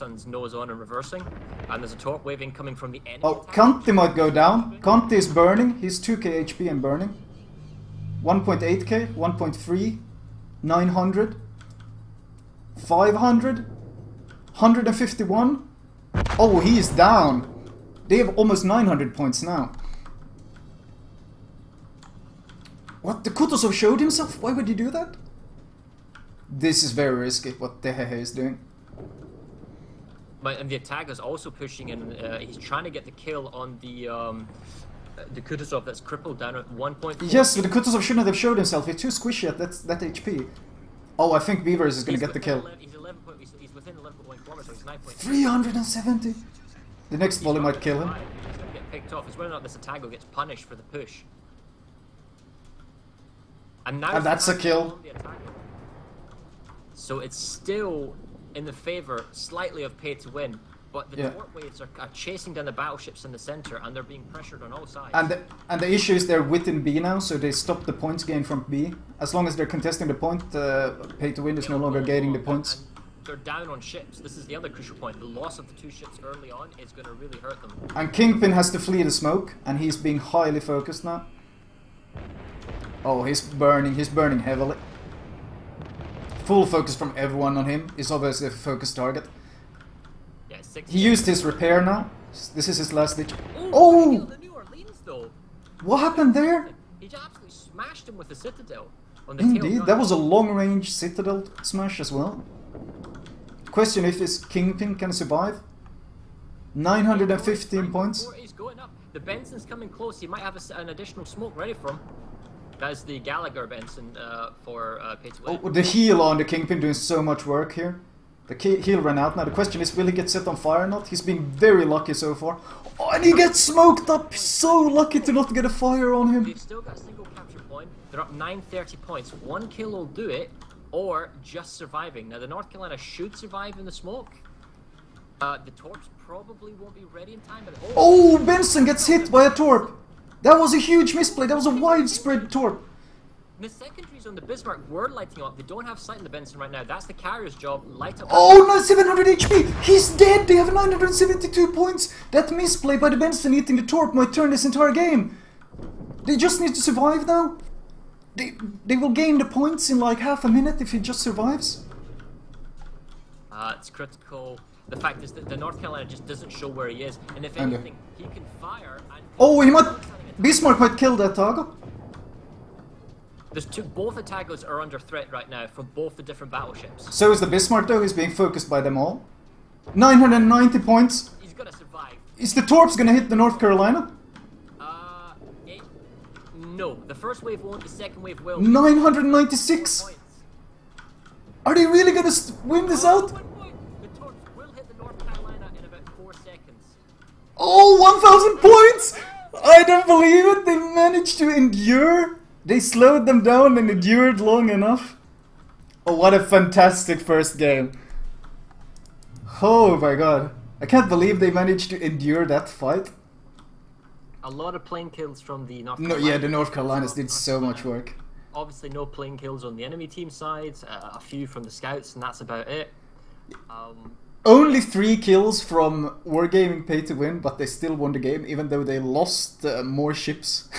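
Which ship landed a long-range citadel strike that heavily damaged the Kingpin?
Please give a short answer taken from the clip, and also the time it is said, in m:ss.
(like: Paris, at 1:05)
Orleans, at 1:34.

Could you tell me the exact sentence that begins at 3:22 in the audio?
They slowed them down and endured long enough.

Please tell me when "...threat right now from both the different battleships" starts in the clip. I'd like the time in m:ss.
2:54.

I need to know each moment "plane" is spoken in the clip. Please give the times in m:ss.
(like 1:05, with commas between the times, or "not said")
3:34, 3:39.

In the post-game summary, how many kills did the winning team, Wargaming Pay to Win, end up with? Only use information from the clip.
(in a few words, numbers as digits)
3.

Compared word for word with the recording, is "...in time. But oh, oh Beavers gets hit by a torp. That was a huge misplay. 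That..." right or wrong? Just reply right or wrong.
wrong.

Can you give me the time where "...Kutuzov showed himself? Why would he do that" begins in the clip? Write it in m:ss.
0:23.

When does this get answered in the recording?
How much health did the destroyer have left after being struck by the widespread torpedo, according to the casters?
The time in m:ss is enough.
2:28.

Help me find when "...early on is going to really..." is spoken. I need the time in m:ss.
1:16.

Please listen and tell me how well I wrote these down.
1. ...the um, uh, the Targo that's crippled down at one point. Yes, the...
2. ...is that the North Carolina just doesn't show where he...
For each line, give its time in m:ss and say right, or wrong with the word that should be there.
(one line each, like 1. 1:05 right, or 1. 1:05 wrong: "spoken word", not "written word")
1. 0:33 wrong: "Kutuzov", not "Targo"
2. 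2:45 right.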